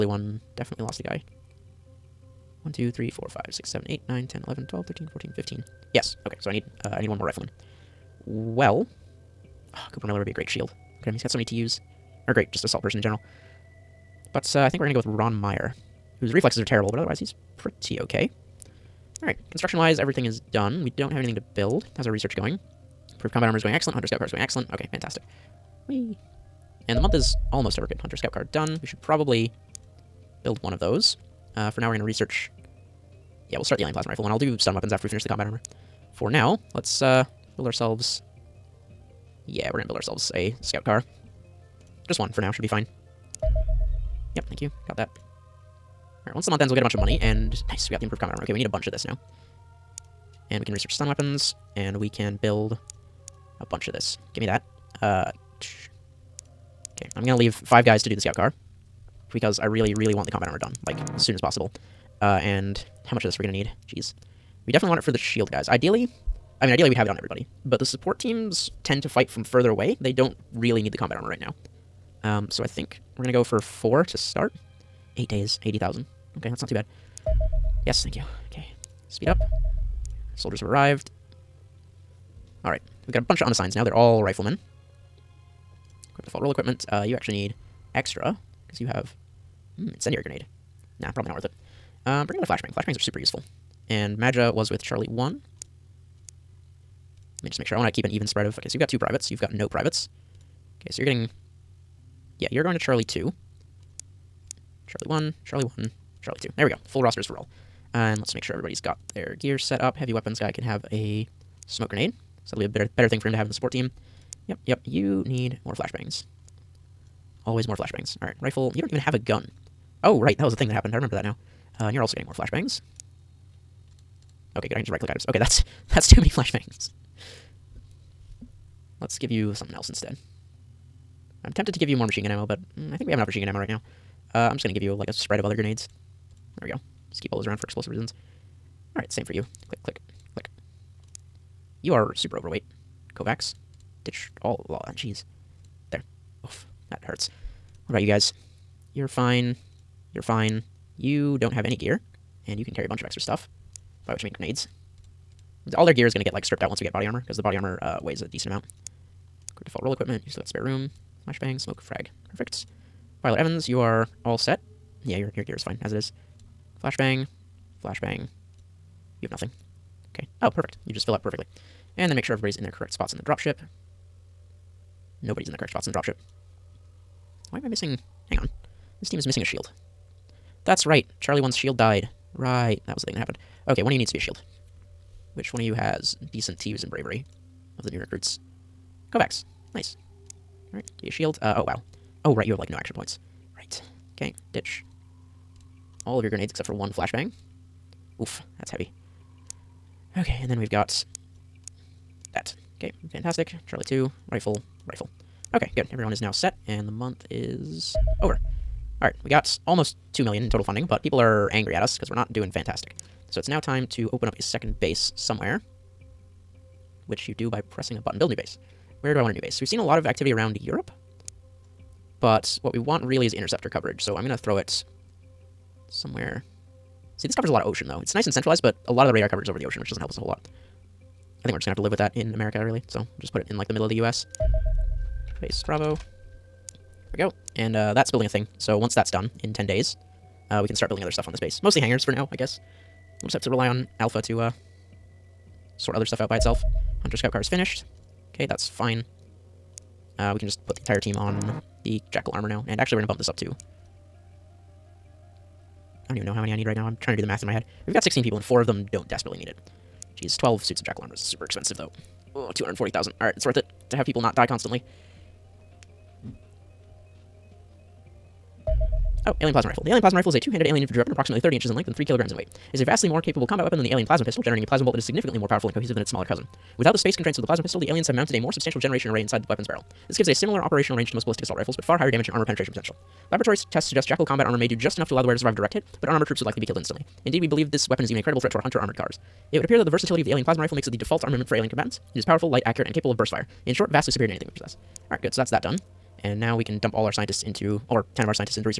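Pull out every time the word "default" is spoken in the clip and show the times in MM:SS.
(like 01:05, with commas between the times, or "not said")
01:26, 02:39, 04:50.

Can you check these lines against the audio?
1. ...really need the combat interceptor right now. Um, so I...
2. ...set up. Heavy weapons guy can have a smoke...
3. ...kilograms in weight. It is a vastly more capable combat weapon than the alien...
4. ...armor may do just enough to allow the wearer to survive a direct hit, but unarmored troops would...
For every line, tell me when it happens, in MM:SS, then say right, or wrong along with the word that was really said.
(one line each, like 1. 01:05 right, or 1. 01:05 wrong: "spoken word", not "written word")
1. 01:10 wrong: "armor", not "interceptor"
2. 01:49 right
3. 04:32 right
4. 04:44 right.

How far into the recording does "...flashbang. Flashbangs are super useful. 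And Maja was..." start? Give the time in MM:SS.
01:32.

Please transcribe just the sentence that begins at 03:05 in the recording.
Which one of you has decent TUs and bravery of the new recruits?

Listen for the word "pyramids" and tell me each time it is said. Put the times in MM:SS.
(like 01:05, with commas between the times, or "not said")
not said.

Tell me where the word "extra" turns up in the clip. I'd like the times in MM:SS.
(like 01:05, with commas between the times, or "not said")
01:27, 02:33.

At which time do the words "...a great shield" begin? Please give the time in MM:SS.
00:10.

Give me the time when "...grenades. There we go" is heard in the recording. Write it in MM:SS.
02:15.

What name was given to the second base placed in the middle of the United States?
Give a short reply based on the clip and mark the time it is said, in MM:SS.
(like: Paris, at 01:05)
Base Bravo, at 03:55.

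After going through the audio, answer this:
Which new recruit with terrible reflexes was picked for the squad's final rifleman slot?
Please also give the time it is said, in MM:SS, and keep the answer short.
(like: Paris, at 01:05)
Ron Meyer, at 00:15.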